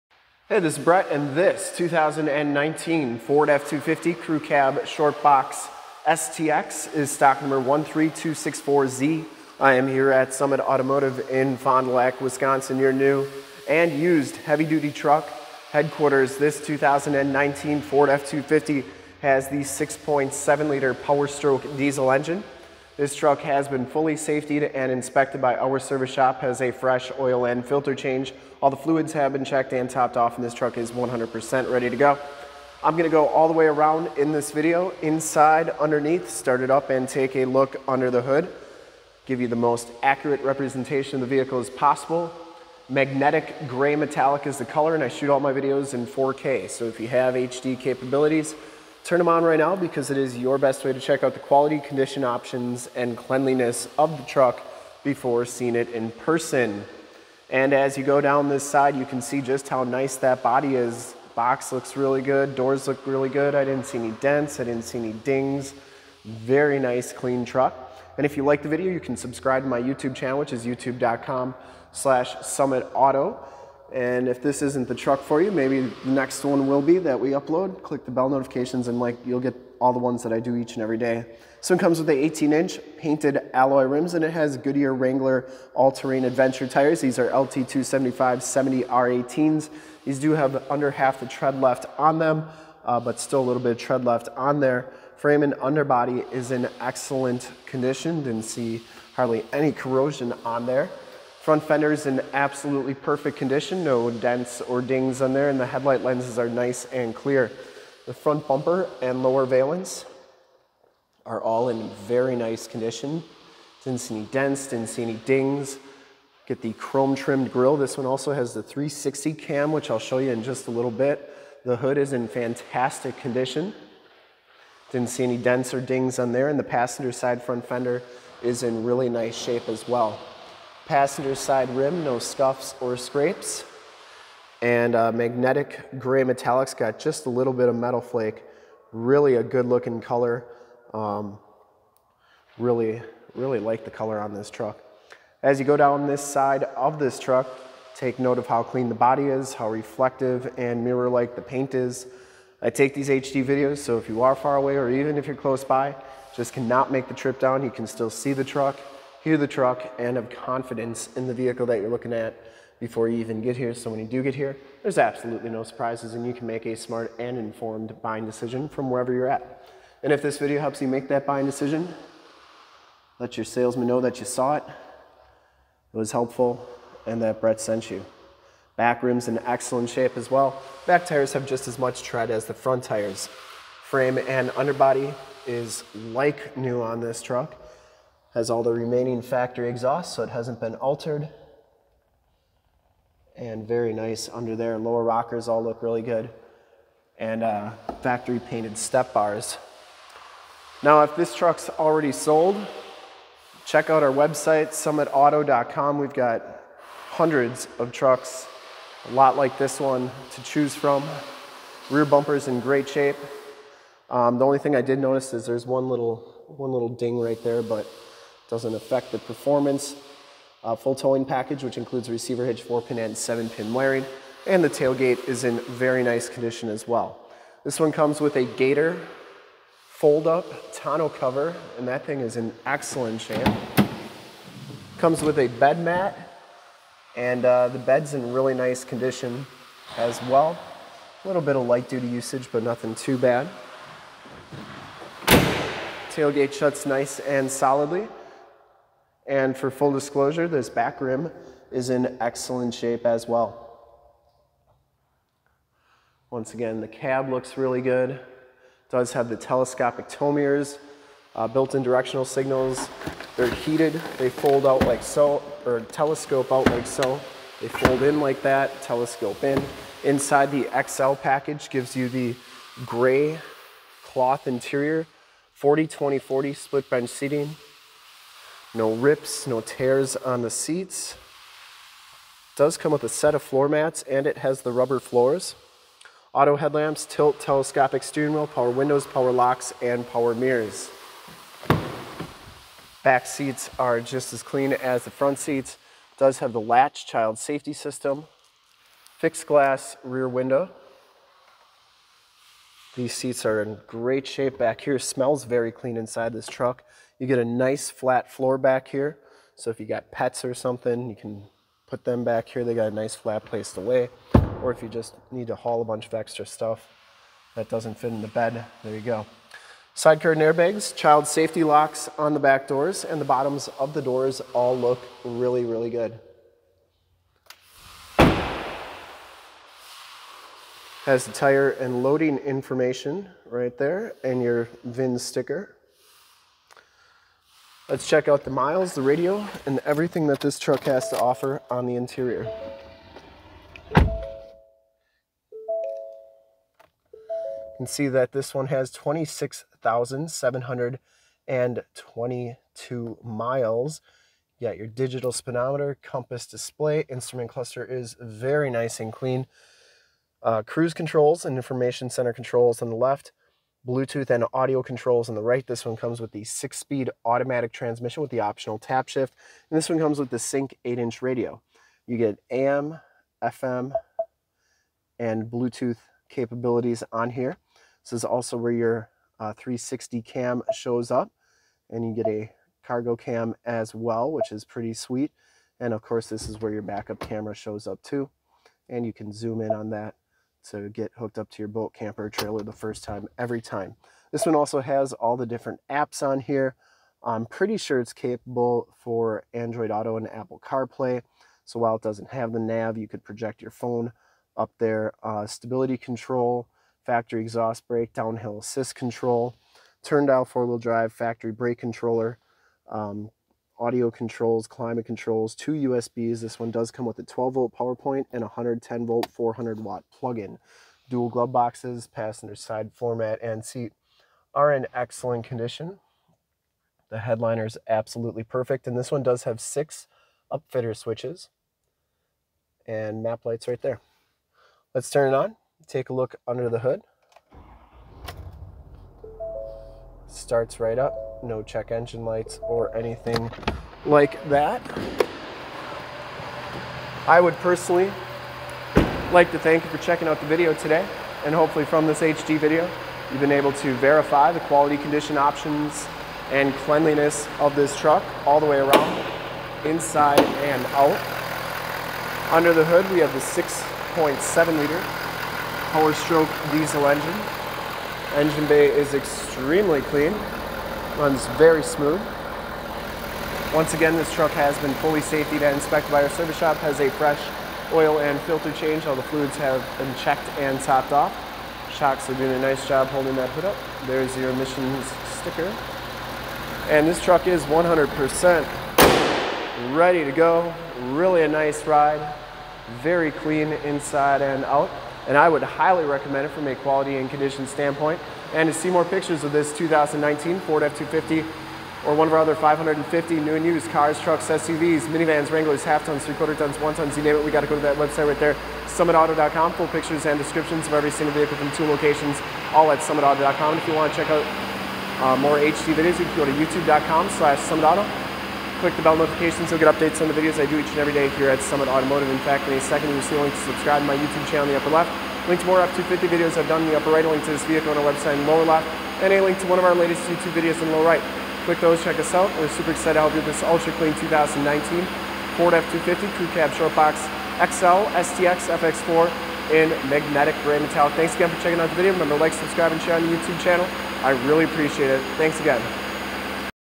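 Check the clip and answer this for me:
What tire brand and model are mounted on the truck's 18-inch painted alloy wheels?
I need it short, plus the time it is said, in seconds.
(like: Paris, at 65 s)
Goodyear Wrangler all-terrain adventure, at 84 s.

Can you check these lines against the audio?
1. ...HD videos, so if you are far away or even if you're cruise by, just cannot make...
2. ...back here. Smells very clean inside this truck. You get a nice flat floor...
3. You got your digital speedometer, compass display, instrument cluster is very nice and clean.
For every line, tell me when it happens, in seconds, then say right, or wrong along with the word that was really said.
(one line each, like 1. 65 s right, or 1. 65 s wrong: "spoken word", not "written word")
1. 153 s wrong: "close", not "cruise"
2. 304 s right
3. 354 s right.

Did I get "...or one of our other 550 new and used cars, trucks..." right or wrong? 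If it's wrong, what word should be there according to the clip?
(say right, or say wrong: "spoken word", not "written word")
right.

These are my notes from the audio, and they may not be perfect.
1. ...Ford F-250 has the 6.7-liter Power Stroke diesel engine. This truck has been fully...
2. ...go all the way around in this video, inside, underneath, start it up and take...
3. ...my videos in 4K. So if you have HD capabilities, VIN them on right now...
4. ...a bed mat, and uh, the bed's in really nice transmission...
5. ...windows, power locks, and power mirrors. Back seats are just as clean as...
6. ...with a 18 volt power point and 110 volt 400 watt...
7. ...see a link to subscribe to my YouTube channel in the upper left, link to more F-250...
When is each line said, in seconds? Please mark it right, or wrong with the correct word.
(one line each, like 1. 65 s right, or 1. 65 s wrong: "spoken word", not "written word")
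1. 17 s right
2. 33 s right
3. 45 s wrong: "Turn", not "VIN"
4. 235 s wrong: "condition", not "transmission"
5. 288 s right
6. 417 s wrong: "12", not "18"
7. 523 s right.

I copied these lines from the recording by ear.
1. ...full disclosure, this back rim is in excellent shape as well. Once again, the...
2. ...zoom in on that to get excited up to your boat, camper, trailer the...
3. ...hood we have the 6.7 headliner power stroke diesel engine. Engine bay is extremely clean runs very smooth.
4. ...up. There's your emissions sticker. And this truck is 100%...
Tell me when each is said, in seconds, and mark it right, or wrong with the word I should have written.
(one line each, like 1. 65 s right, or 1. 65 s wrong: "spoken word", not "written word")
1. 249 s right
2. 389 s wrong: "hooked", not "excited"
3. 462 s wrong: "liter", not "headliner"
4. 483 s right.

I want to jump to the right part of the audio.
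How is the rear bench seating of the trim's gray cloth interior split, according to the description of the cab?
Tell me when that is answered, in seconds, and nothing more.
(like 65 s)
275 s.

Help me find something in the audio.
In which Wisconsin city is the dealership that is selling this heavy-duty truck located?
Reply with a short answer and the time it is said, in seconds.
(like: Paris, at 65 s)
Fond du Lac, at 11 s.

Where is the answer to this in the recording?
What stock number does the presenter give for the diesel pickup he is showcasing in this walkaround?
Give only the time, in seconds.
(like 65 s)
7 s.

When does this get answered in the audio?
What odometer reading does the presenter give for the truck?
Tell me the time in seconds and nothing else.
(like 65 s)
348 s.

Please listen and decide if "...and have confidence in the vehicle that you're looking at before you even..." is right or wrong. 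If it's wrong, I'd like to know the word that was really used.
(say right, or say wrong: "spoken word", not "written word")
right.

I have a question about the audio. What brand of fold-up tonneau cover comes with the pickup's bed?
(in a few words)
Gator.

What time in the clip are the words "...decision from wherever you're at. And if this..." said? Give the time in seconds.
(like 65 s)
168 s.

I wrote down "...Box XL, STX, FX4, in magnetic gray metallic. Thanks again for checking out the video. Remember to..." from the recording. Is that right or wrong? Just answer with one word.
right.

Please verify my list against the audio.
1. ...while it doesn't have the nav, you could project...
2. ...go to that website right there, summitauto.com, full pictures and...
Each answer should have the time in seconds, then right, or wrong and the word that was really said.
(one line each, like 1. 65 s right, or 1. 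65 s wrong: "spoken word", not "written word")
1. 401 s right
2. 507 s right.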